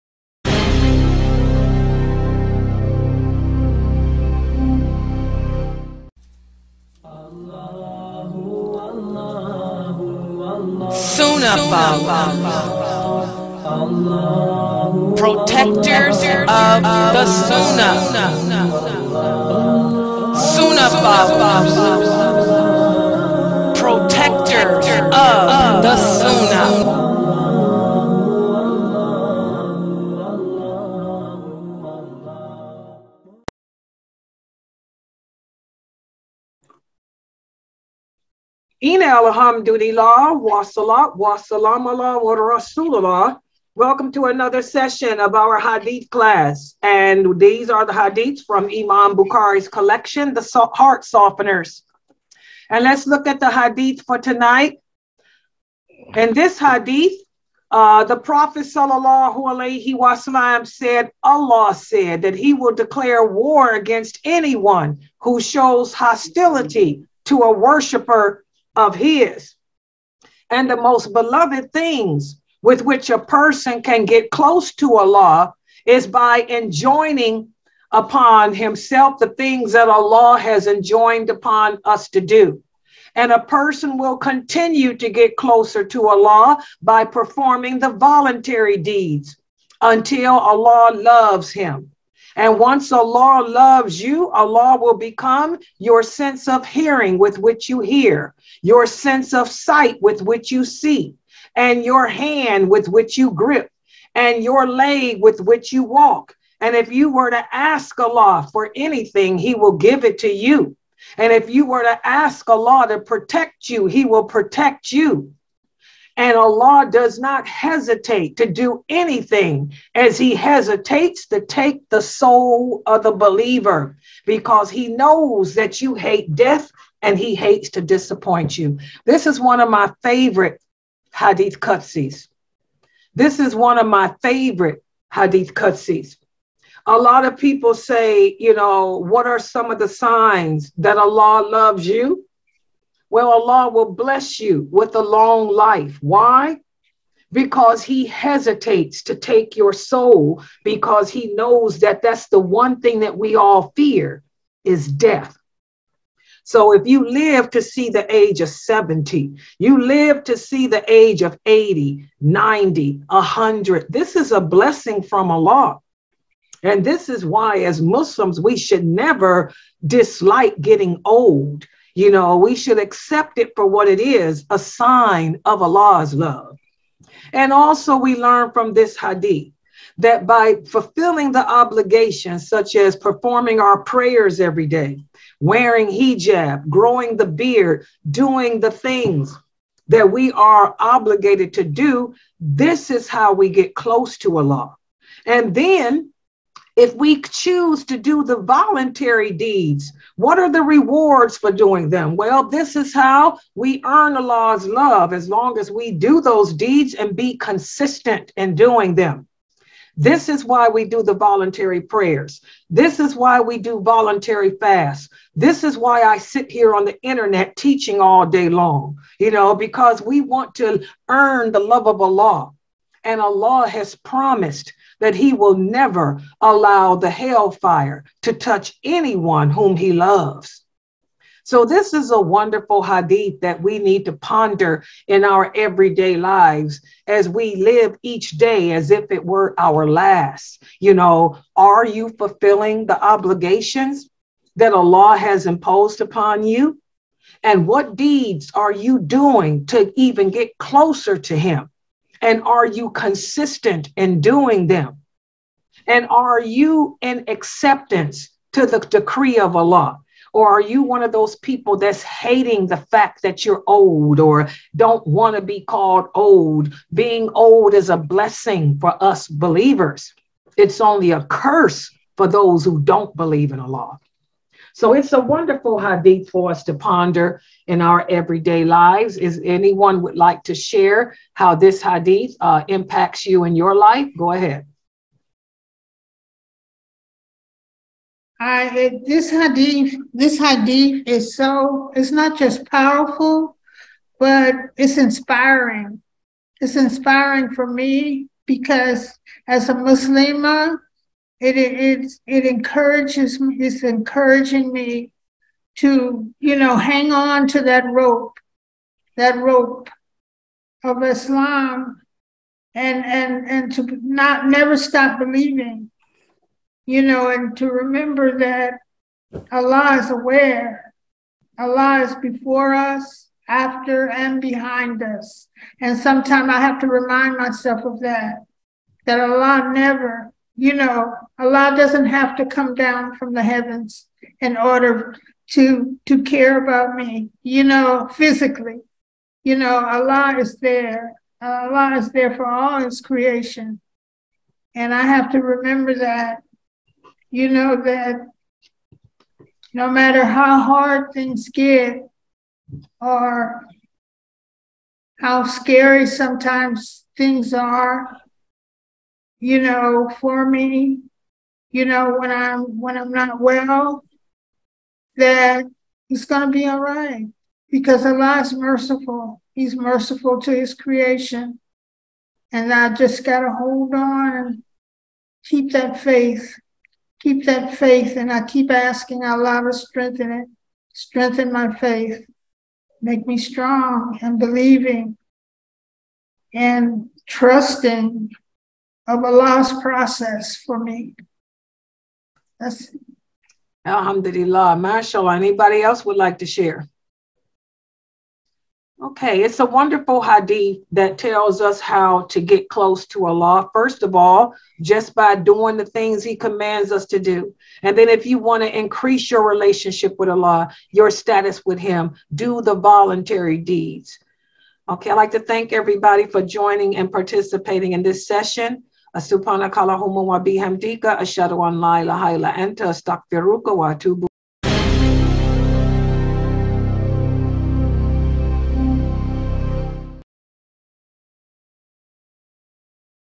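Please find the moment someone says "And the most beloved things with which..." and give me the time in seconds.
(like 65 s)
70 s.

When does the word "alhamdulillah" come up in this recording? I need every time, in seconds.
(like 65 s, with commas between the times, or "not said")
39 s, 393 s.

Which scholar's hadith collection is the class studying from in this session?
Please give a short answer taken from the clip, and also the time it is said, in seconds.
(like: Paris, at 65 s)
Imam Bukhari, at 48 s.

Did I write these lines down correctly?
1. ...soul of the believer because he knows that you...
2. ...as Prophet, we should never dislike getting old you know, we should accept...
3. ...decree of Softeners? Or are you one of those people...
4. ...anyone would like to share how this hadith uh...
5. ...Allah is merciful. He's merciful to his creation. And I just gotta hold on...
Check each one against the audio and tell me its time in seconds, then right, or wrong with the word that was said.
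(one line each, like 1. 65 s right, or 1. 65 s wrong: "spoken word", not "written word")
1. 122 s right
2. 167 s wrong: "Muslims", not "Prophet"
3. 258 s wrong: "Allah", not "Softeners"
4. 279 s right
5. 368 s right.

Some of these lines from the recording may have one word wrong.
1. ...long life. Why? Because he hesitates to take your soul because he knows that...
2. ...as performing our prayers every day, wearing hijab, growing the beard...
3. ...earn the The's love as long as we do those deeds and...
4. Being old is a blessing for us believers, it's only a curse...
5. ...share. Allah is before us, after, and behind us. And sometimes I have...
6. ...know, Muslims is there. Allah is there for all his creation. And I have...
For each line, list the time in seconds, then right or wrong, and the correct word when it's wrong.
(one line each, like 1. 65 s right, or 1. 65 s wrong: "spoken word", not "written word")
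1. 145 s right
2. 182 s right
3. 203 s wrong: "Lord", not "The"
4. 266 s right
5. 320 s wrong: "aware", not "share"
6. 339 s wrong: "Allah", not "Muslims".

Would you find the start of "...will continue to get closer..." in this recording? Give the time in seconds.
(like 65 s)
83 s.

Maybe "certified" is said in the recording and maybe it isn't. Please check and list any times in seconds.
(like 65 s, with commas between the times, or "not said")
not said.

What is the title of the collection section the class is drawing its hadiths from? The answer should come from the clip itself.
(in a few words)
The Heart Softeners.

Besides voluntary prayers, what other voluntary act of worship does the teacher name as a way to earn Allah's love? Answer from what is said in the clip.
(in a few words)
Voluntary fasts.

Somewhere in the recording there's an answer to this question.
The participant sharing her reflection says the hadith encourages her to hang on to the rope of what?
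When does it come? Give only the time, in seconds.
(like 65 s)
311 s.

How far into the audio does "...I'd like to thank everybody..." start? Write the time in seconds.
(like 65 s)
415 s.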